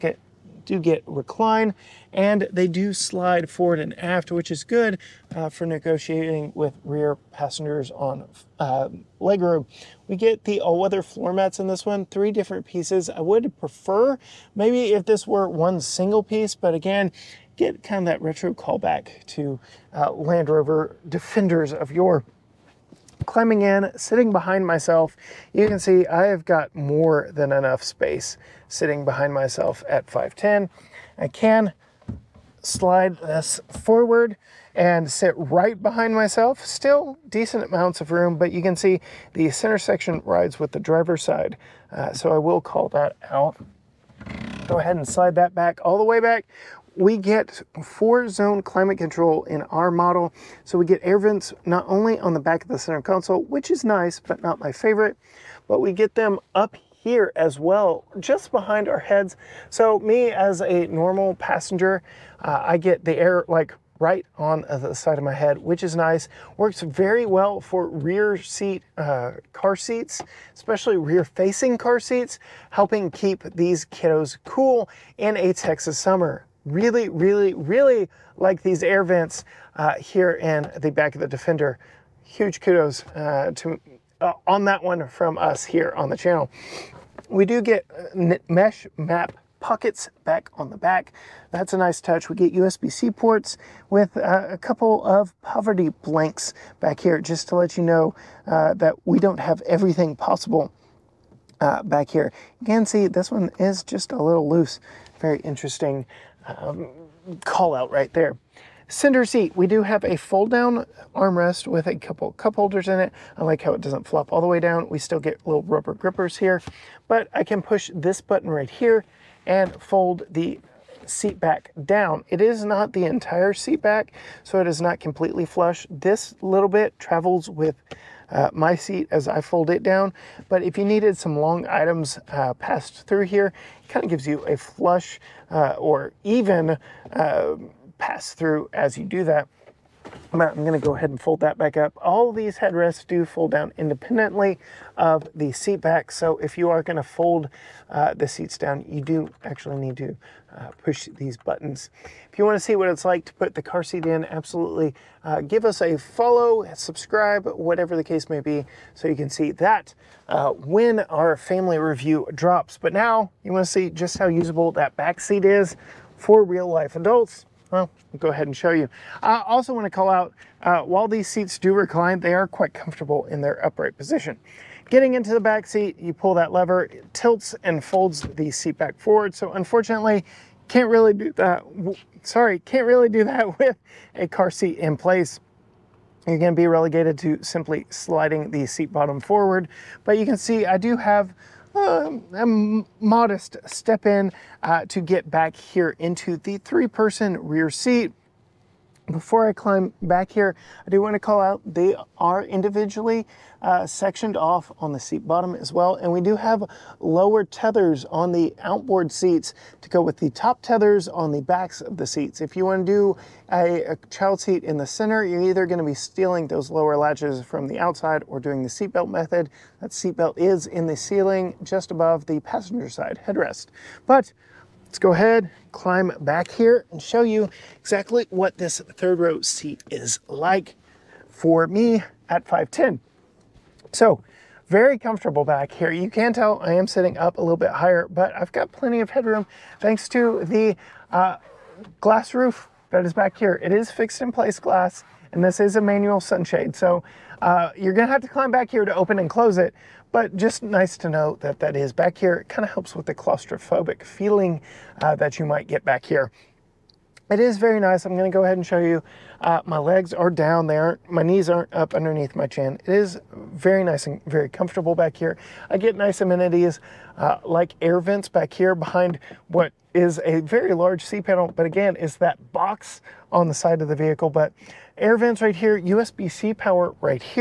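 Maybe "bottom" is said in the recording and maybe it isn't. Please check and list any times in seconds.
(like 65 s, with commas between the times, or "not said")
188 s, 205 s.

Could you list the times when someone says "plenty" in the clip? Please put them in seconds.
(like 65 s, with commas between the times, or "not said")
238 s.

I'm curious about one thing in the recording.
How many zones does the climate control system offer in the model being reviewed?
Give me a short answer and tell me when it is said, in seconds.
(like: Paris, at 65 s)
4, at 47 s.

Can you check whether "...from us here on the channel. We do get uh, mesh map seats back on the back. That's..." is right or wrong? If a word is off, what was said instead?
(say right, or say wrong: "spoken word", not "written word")
wrong: "pockets", not "seats".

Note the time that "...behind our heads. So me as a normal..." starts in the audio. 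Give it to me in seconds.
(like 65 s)
58 s.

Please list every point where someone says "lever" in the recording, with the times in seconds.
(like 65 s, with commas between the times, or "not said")
176 s.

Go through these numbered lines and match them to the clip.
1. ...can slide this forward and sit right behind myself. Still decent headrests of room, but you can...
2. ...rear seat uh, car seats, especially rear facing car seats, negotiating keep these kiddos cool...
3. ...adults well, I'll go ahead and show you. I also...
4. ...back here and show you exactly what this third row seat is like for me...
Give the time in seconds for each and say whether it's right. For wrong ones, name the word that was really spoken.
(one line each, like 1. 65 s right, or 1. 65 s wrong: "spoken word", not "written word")
1. 31 s wrong: "amounts", not "headrests"
2. 67 s wrong: "helping", not "negotiating"
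3. 166 s right
4. 226 s right.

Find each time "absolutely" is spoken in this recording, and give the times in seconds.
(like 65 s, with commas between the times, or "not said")
154 s.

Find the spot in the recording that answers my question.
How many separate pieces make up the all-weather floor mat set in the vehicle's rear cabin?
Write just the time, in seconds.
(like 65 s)
12 s.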